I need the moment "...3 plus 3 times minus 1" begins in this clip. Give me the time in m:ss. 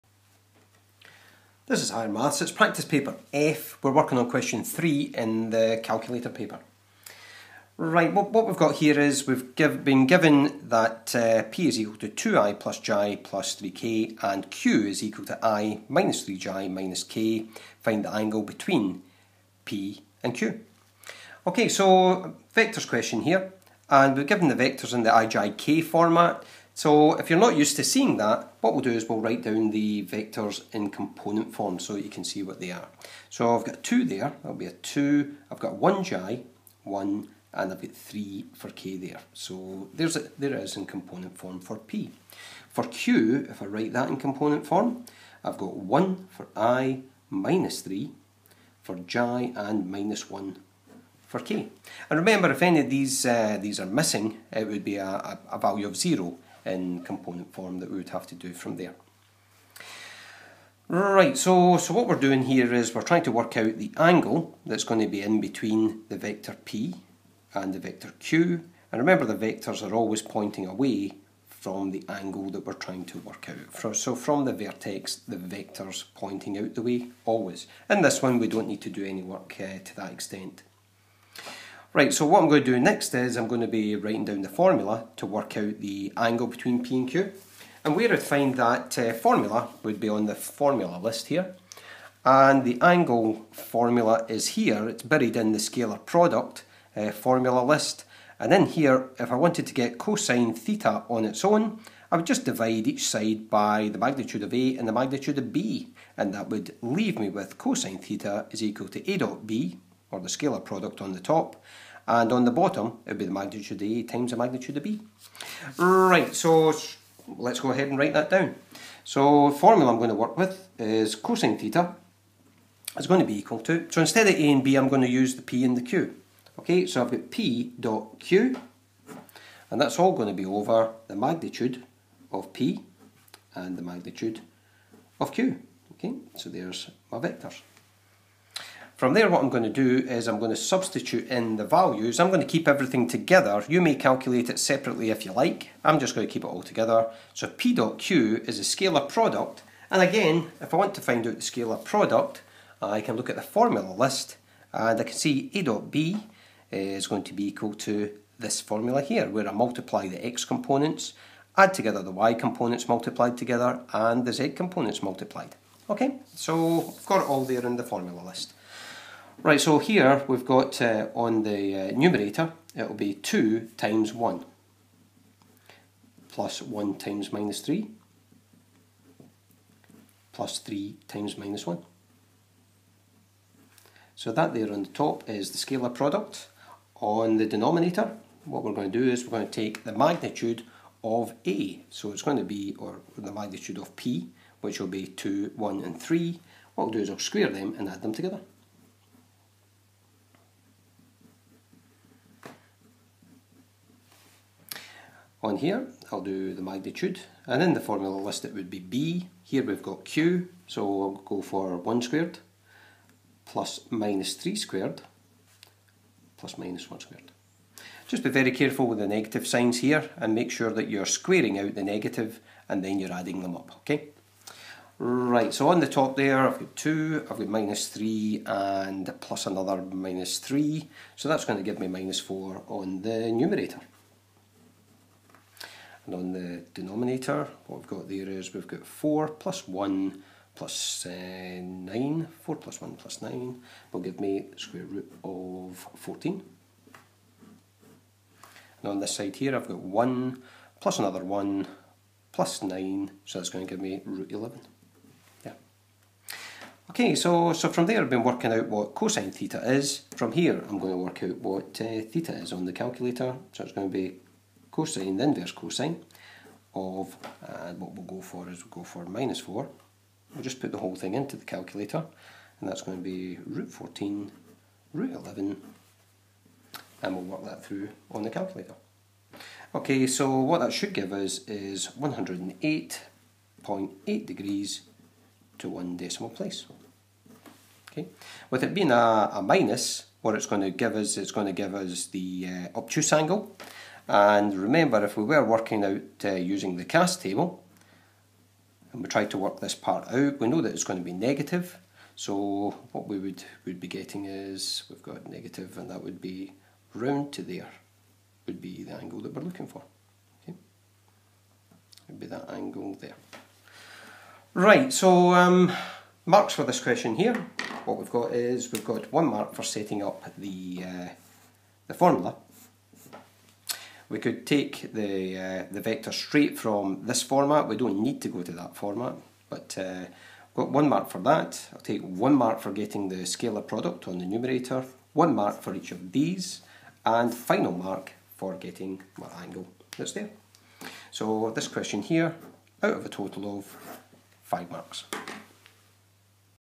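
2:57.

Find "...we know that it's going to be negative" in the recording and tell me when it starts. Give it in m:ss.
5:00.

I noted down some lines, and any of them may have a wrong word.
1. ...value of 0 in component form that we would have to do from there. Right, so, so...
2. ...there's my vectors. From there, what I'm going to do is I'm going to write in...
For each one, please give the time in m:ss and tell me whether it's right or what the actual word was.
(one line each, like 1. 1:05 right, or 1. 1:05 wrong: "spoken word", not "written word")
1. 0:55 right
2. 2:16 wrong: "substitute", not "write".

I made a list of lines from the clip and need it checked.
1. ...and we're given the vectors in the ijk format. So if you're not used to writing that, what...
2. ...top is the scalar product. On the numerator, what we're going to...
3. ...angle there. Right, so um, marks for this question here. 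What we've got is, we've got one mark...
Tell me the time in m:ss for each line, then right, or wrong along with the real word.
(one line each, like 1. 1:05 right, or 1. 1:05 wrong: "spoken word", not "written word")
1. 0:23 wrong: "seeing", not "writing"
2. 3:04 wrong: "denominator", not "numerator"
3. 5:12 right.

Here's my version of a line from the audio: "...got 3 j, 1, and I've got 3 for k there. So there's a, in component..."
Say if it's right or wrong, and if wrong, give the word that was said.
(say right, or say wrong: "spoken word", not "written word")
wrong: "1", not "3".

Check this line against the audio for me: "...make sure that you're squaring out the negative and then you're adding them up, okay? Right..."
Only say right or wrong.
right.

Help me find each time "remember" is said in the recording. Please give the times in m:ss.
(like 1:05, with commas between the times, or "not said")
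0:52, 1:08, 4:54.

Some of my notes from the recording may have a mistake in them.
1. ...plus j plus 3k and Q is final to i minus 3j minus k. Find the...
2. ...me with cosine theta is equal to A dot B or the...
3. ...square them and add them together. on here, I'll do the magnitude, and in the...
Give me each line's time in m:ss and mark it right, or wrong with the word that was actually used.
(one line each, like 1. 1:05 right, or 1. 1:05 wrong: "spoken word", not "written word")
1. 0:12 wrong: "equal", not "final"
2. 1:47 right
3. 3:17 right.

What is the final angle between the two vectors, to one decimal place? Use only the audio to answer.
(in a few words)
108.8 degrees.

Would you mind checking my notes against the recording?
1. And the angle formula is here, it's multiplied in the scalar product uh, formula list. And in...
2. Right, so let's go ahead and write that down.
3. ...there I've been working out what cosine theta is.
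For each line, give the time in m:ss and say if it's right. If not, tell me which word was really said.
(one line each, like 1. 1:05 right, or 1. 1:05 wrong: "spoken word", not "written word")
1. 1:32 wrong: "buried", not "multiplied"
2. 1:55 right
3. 4:17 right.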